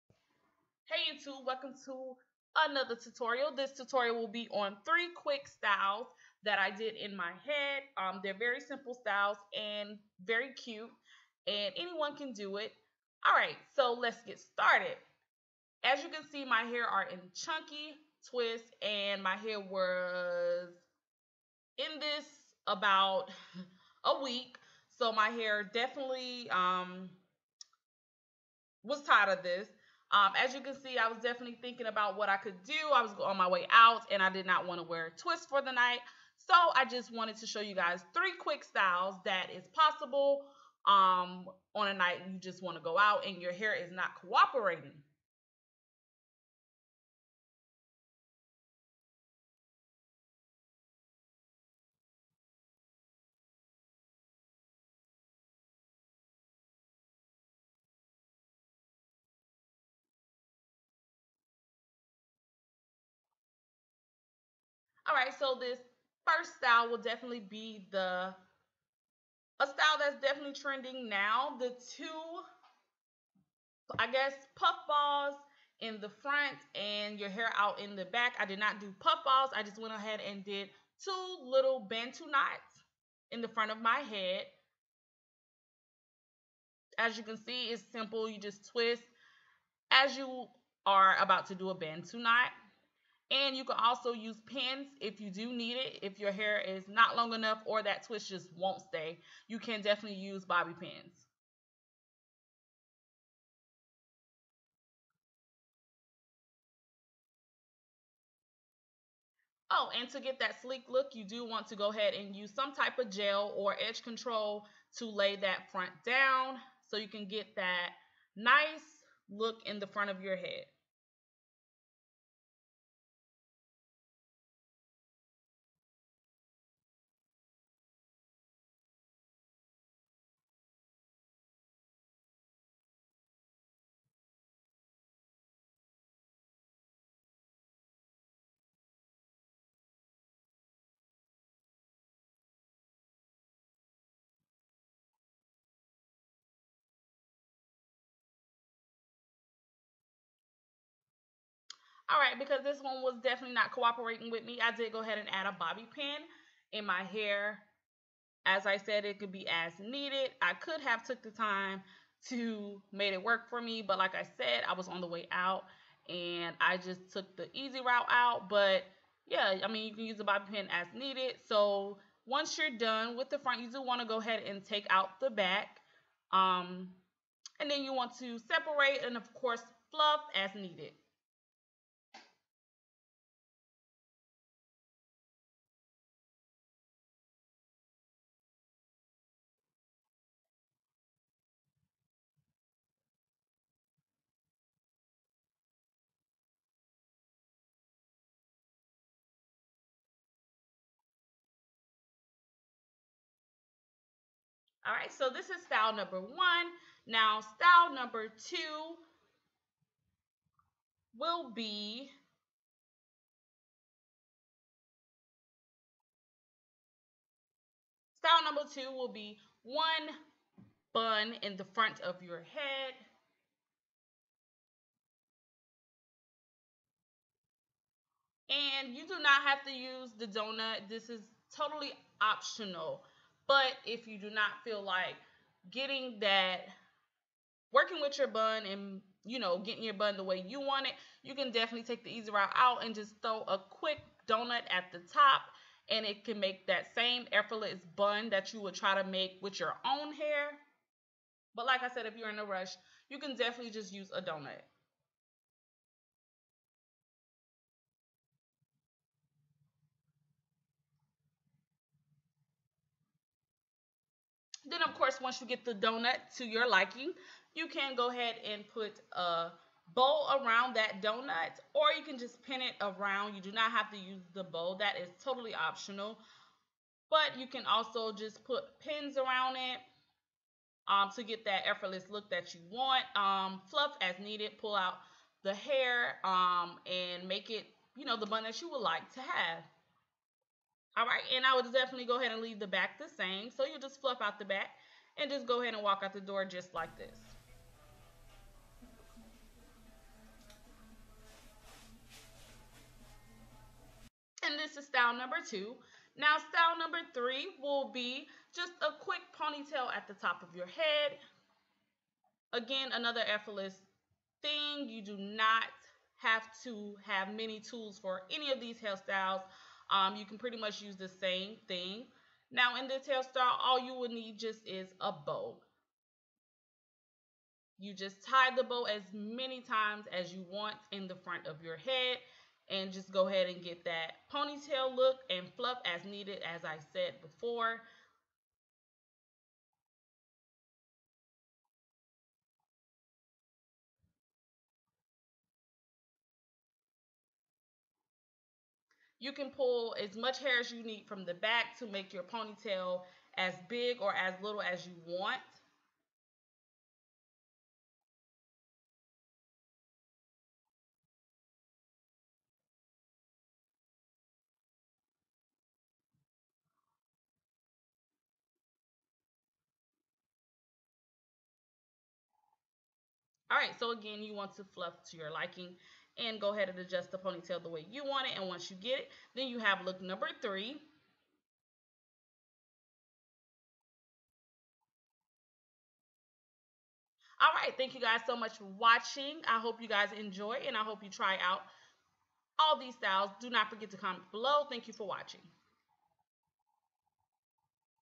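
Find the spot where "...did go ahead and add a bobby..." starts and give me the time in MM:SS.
02:34.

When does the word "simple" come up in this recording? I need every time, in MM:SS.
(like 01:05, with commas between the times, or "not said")
00:08, 01:27.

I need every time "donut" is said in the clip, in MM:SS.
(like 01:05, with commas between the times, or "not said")
03:50, 04:04, 04:14, 04:25, 04:31.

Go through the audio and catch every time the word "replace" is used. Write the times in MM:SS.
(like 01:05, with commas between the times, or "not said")
not said.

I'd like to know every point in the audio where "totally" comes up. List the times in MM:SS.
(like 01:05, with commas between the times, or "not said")
03:51, 04:35.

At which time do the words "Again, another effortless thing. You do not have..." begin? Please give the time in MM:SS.
05:12.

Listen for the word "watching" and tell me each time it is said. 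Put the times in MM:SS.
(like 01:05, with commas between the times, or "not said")
06:28, 06:35.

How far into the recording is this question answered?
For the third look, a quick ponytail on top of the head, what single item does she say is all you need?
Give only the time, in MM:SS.
05:25.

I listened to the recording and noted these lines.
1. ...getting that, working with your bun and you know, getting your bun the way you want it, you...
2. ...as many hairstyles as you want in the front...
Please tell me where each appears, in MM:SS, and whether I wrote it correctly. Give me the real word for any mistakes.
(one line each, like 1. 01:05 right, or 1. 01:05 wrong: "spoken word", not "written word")
1. 03:55 right
2. 05:28 wrong: "times", not "hairstyles".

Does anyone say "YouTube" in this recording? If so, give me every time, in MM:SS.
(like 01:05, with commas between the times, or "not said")
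00:01.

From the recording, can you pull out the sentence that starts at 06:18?
And once you get it, then you have look number three.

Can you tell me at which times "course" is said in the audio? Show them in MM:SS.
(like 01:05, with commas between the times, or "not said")
02:59, 04:24.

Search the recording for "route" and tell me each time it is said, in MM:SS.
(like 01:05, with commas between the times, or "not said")
02:47, 04:02.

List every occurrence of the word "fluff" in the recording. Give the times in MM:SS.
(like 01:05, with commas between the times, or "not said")
02:59, 04:43, 04:54, 05:35, 06:14.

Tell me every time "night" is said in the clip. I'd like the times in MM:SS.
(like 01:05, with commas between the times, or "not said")
00:35, 00:41.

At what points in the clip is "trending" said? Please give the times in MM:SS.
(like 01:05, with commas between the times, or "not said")
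01:10.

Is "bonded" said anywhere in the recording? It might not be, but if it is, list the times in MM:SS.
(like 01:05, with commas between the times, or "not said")
not said.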